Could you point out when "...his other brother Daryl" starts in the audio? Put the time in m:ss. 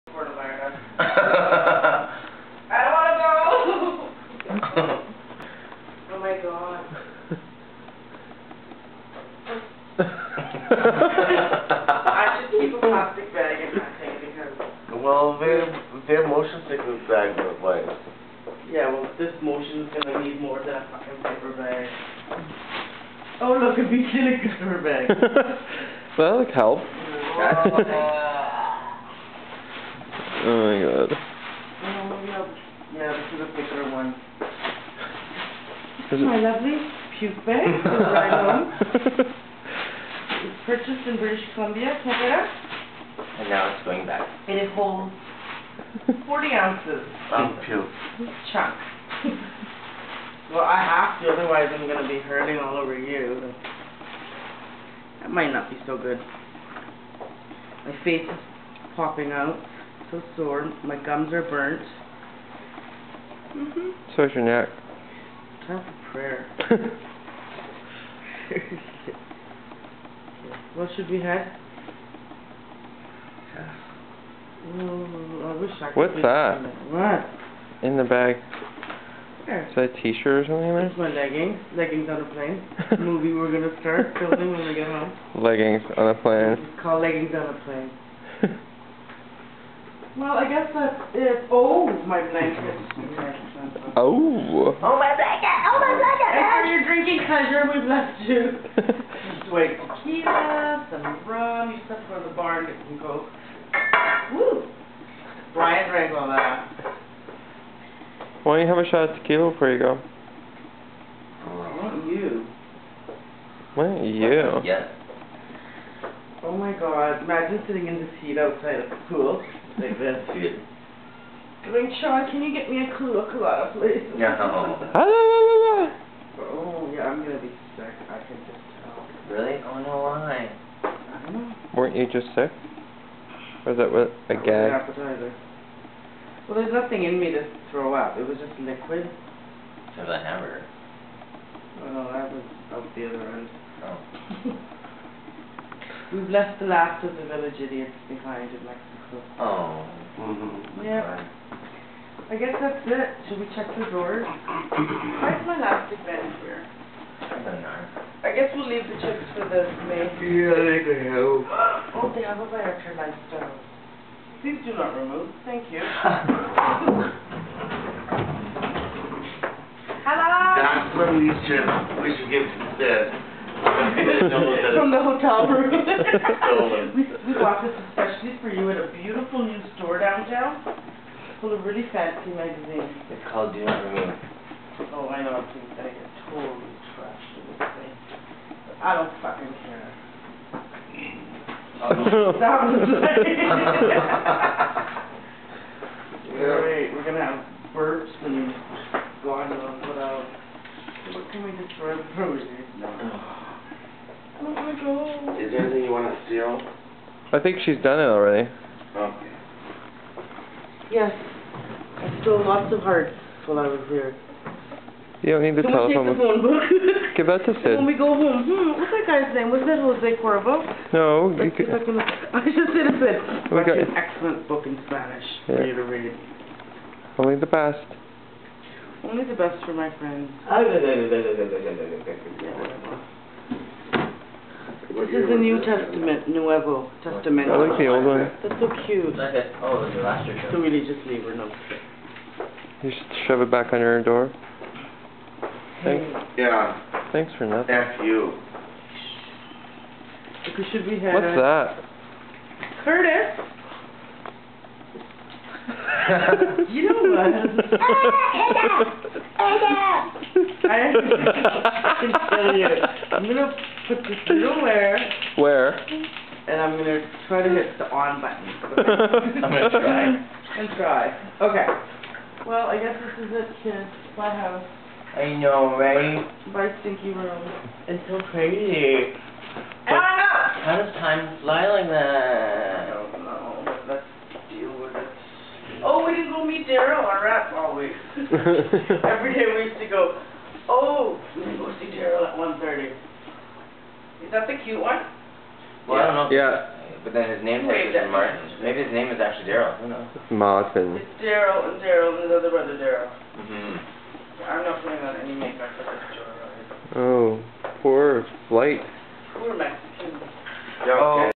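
5:02.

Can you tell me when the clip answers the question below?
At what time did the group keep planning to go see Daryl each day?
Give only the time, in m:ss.
4:52.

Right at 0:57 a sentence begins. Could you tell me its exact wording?
My face is popping out, so sore.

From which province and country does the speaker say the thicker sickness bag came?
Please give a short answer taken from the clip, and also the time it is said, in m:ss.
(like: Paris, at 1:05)
British Columbia, Canada, at 0:41.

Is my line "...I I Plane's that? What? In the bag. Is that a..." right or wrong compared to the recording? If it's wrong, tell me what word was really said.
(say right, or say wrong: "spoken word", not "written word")
wrong: "What", not "Plane".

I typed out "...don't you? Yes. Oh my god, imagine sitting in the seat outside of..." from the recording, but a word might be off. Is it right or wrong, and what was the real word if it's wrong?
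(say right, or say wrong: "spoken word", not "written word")
right.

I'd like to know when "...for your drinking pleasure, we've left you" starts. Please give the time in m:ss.
1:36.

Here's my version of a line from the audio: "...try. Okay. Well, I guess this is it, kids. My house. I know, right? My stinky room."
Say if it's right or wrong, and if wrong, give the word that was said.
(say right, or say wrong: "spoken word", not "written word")
right.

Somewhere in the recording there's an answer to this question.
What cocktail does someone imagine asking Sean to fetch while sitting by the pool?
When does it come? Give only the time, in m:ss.
2:02.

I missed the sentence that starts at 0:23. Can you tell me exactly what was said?
Oh, look, it beats in a paper bag.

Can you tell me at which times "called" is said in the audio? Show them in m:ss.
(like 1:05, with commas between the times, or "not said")
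1:26, 3:03.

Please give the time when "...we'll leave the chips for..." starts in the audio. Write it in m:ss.
2:38.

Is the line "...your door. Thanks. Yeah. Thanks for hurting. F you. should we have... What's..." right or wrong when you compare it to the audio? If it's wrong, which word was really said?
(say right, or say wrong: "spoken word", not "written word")
wrong: "nothing", not "hurting".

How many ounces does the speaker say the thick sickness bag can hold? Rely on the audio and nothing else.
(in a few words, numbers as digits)
40.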